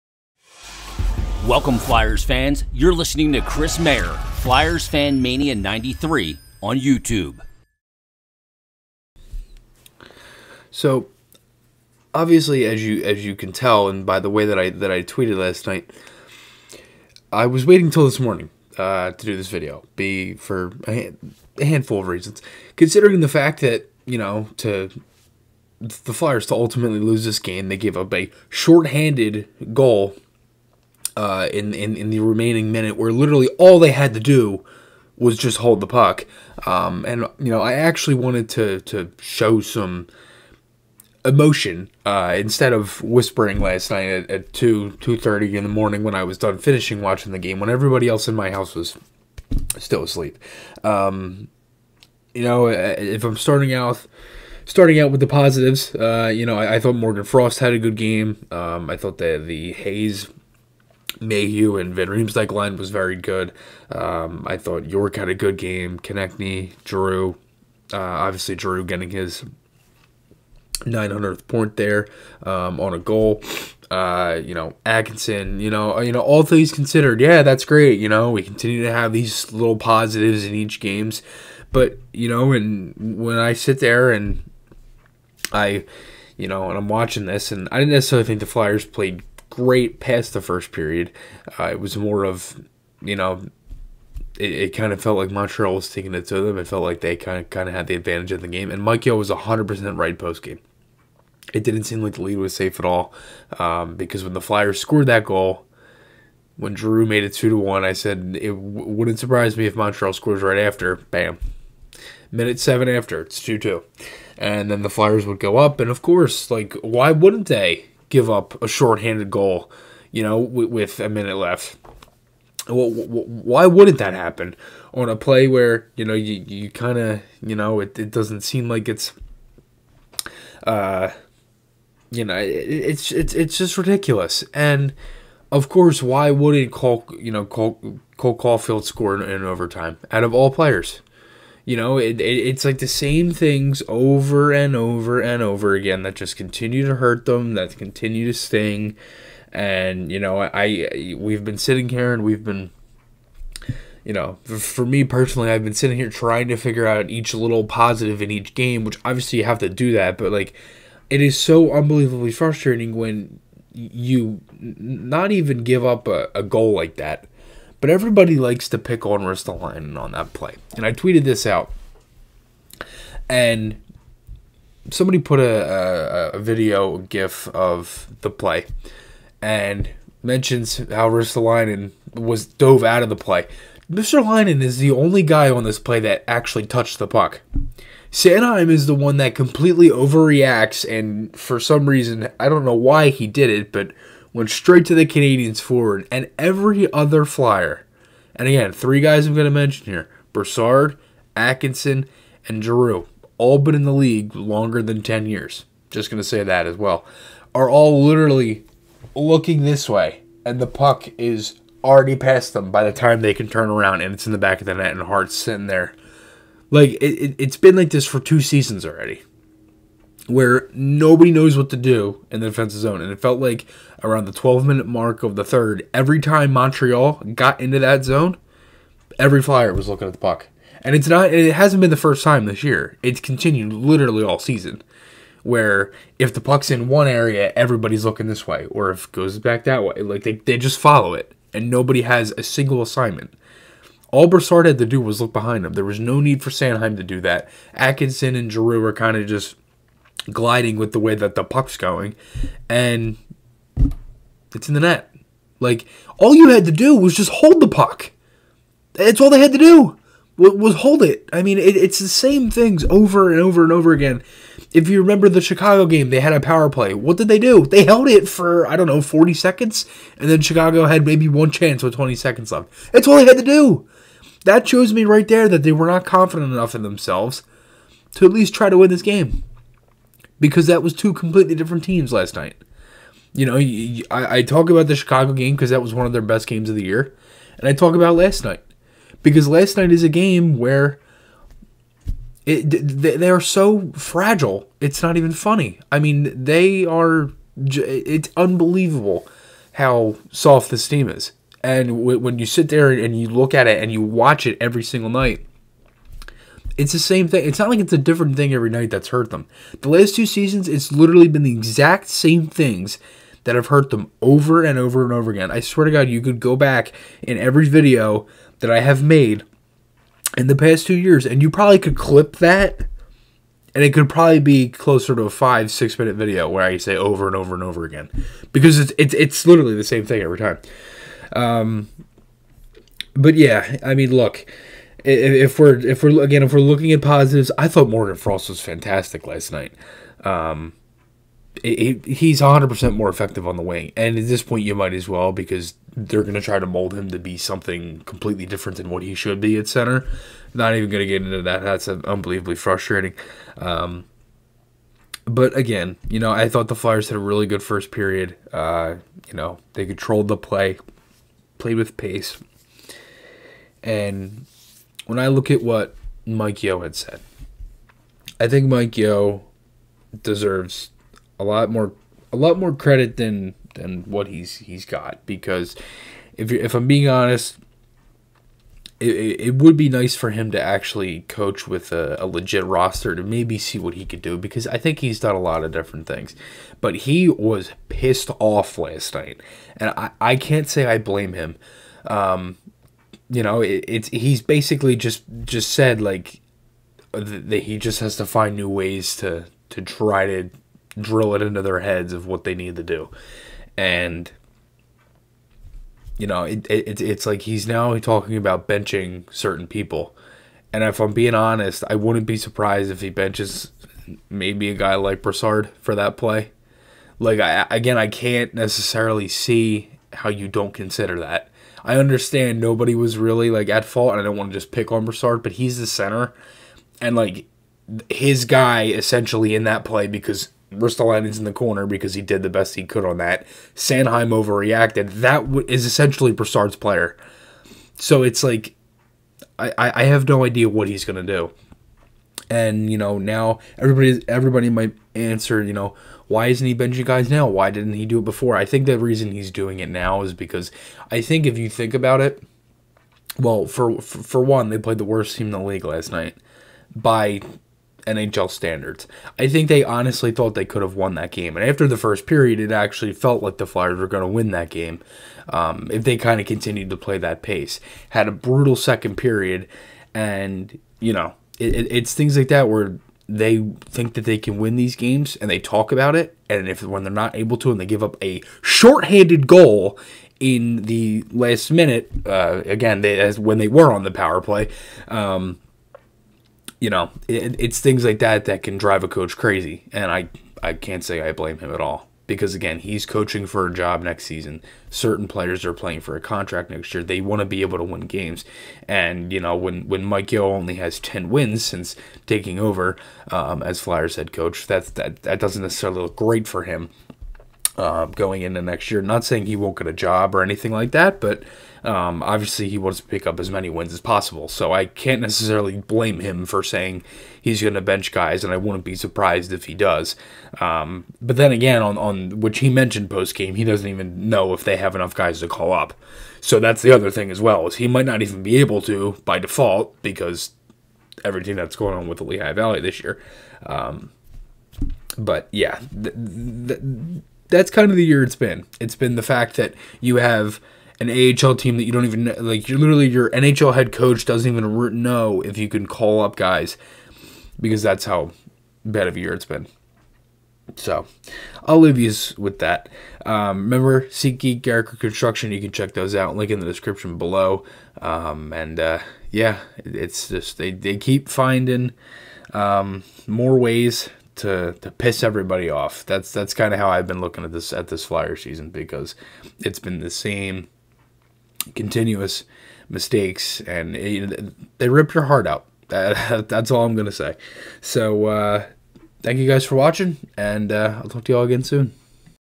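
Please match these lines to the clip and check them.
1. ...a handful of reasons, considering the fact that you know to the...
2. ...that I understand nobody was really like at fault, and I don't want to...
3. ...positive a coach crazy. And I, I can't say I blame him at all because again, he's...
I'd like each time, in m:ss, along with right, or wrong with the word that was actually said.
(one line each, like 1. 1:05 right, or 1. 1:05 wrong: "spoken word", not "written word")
1. 0:21 right
2. 7:01 right
3. 8:08 wrong: "drive", not "positive".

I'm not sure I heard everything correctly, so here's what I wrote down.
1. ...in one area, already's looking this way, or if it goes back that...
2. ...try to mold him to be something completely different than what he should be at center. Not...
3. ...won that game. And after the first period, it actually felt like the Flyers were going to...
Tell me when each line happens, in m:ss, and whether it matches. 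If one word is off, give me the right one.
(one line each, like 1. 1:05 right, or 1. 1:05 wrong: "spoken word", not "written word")
1. 3:56 wrong: "everybody", not "already"
2. 5:46 right
3. 7:40 right.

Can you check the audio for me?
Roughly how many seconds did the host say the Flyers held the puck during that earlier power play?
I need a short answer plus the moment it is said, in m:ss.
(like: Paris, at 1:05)
40 seconds, at 4:29.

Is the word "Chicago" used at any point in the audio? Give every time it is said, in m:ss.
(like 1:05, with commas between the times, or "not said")
4:25, 4:30, 4:44.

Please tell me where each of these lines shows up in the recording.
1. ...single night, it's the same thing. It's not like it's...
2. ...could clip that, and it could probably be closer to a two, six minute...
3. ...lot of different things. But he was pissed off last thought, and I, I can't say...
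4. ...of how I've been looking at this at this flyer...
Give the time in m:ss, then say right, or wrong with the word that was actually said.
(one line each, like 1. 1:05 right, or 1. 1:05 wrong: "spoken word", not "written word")
1. 5:04 right
2. 5:21 wrong: "five", not "two"
3. 6:25 wrong: "night", not "thought"
4. 9:26 right.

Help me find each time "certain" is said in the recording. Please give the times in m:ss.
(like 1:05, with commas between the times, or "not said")
6:49, 8:14.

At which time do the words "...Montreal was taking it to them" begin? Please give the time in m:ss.
1:35.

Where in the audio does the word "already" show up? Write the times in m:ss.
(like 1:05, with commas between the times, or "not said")
3:31, 3:38.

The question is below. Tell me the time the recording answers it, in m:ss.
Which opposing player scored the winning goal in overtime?
2:18.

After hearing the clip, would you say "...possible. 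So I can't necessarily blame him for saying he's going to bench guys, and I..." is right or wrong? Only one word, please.
right.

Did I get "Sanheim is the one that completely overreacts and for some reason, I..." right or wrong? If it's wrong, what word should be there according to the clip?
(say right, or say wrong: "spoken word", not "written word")
right.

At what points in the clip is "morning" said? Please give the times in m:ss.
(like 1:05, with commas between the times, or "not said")
0:18, 0:45.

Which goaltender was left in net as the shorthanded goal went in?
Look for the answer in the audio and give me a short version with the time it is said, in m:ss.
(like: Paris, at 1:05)
Hart, at 3:35.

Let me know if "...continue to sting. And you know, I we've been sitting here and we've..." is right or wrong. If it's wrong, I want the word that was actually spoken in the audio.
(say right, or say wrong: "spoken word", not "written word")
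right.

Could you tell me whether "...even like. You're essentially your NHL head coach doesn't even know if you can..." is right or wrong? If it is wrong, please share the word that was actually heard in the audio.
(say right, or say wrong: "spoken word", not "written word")
wrong: "literally", not "essentially".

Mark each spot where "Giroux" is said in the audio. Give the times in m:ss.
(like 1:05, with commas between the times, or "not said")
3:22, 4:08.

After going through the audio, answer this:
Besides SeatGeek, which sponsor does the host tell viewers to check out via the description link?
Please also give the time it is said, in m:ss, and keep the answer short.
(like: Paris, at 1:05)
Garrett Construction, at 9:14.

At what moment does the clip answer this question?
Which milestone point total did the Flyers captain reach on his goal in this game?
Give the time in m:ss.
1:10.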